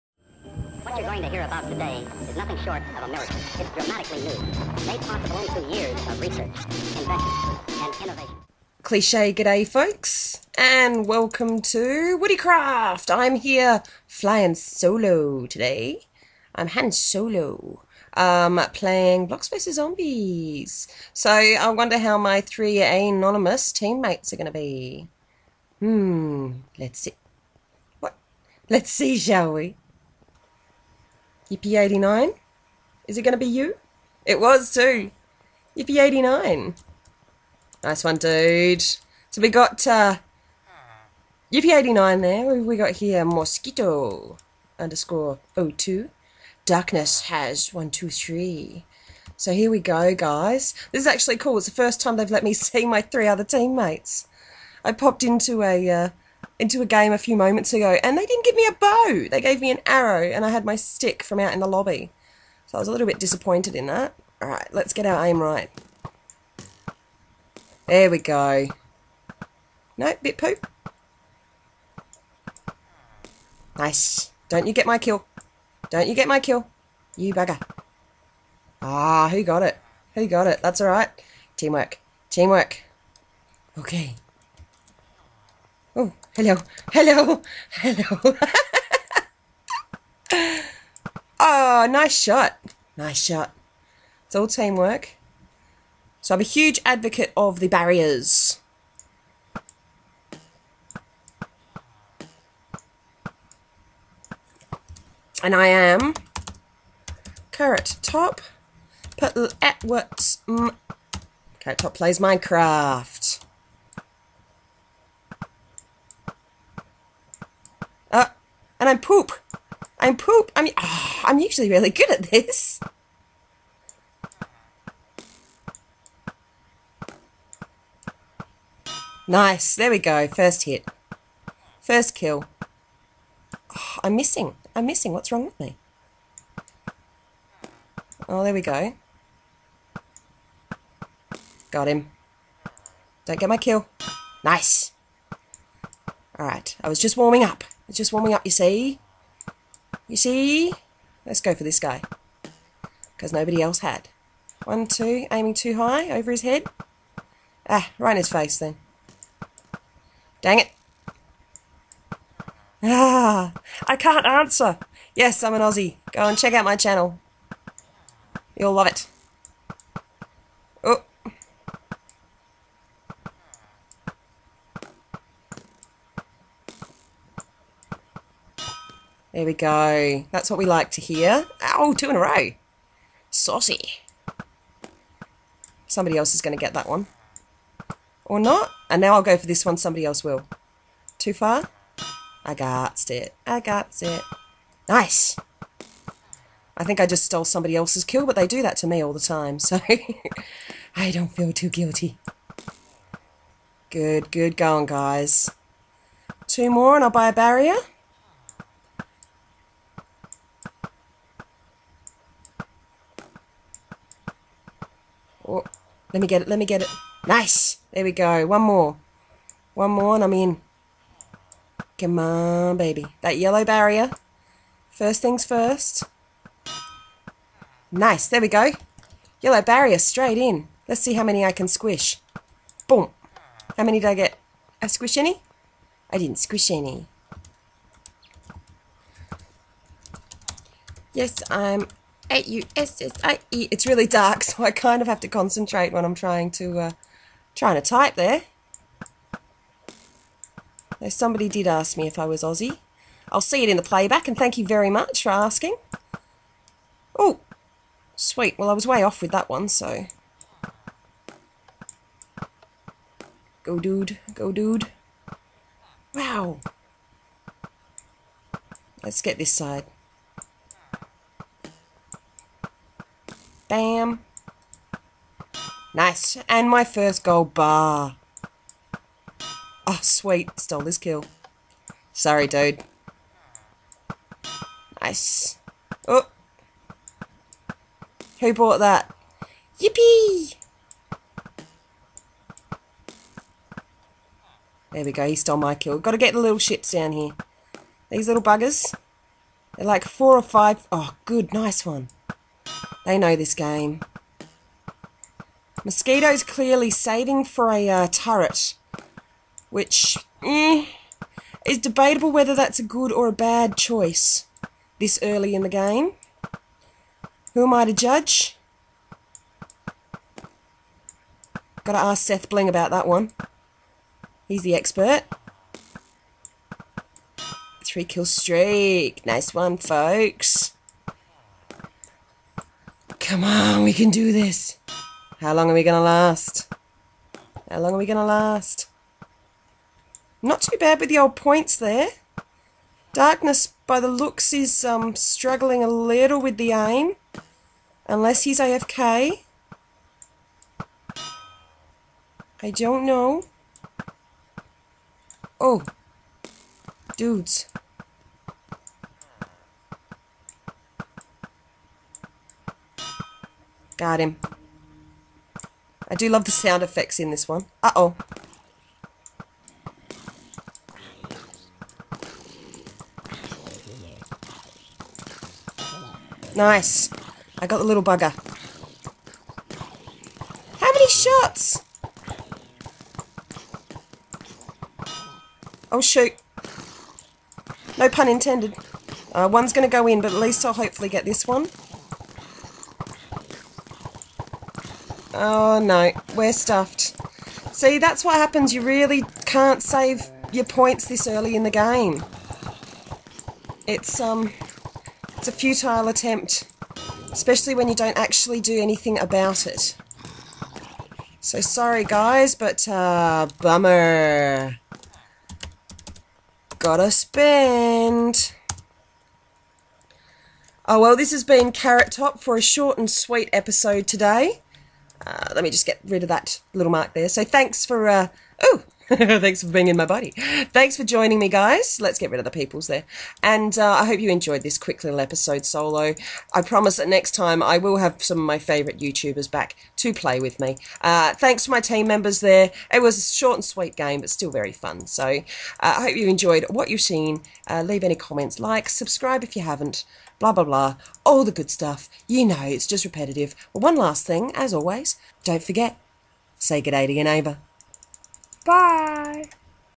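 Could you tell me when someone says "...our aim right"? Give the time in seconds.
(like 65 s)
65 s.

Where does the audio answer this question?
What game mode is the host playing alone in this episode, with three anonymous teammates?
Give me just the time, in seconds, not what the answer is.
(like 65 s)
19 s.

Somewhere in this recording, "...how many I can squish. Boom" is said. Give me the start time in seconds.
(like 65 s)
231 s.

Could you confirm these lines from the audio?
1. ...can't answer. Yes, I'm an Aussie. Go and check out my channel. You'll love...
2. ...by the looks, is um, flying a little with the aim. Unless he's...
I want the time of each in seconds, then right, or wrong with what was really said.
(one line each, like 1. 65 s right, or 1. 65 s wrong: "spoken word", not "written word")
1. 163 s right
2. 343 s wrong: "struggling", not "flying".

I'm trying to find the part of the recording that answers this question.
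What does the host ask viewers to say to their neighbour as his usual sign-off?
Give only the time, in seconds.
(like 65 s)
456 s.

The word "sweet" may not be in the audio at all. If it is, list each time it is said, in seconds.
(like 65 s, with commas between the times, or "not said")
258 s, 280 s, 423 s, 443 s.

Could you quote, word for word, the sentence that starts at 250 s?
Though somebody did ask me if I was Aussie.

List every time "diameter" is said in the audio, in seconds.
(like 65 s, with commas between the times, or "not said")
not said.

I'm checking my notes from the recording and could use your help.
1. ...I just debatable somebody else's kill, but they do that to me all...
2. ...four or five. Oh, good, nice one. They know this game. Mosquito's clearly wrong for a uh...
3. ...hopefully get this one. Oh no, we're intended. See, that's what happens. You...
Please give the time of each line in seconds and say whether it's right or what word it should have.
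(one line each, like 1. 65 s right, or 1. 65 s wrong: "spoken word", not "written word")
1. 196 s wrong: "stole", not "debatable"
2. 300 s wrong: "saving", not "wrong"
3. 390 s wrong: "stuffed", not "intended".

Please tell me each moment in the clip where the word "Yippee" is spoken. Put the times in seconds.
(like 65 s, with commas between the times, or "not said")
31 s, 35 s, 41 s, 289 s.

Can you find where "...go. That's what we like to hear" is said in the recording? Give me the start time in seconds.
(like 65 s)
179 s.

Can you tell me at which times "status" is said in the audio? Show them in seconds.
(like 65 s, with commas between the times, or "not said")
not said.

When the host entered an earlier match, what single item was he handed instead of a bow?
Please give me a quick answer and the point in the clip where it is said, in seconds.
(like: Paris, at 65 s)
An arrow, at 59 s.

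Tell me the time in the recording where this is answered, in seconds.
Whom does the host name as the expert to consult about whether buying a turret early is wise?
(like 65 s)
322 s.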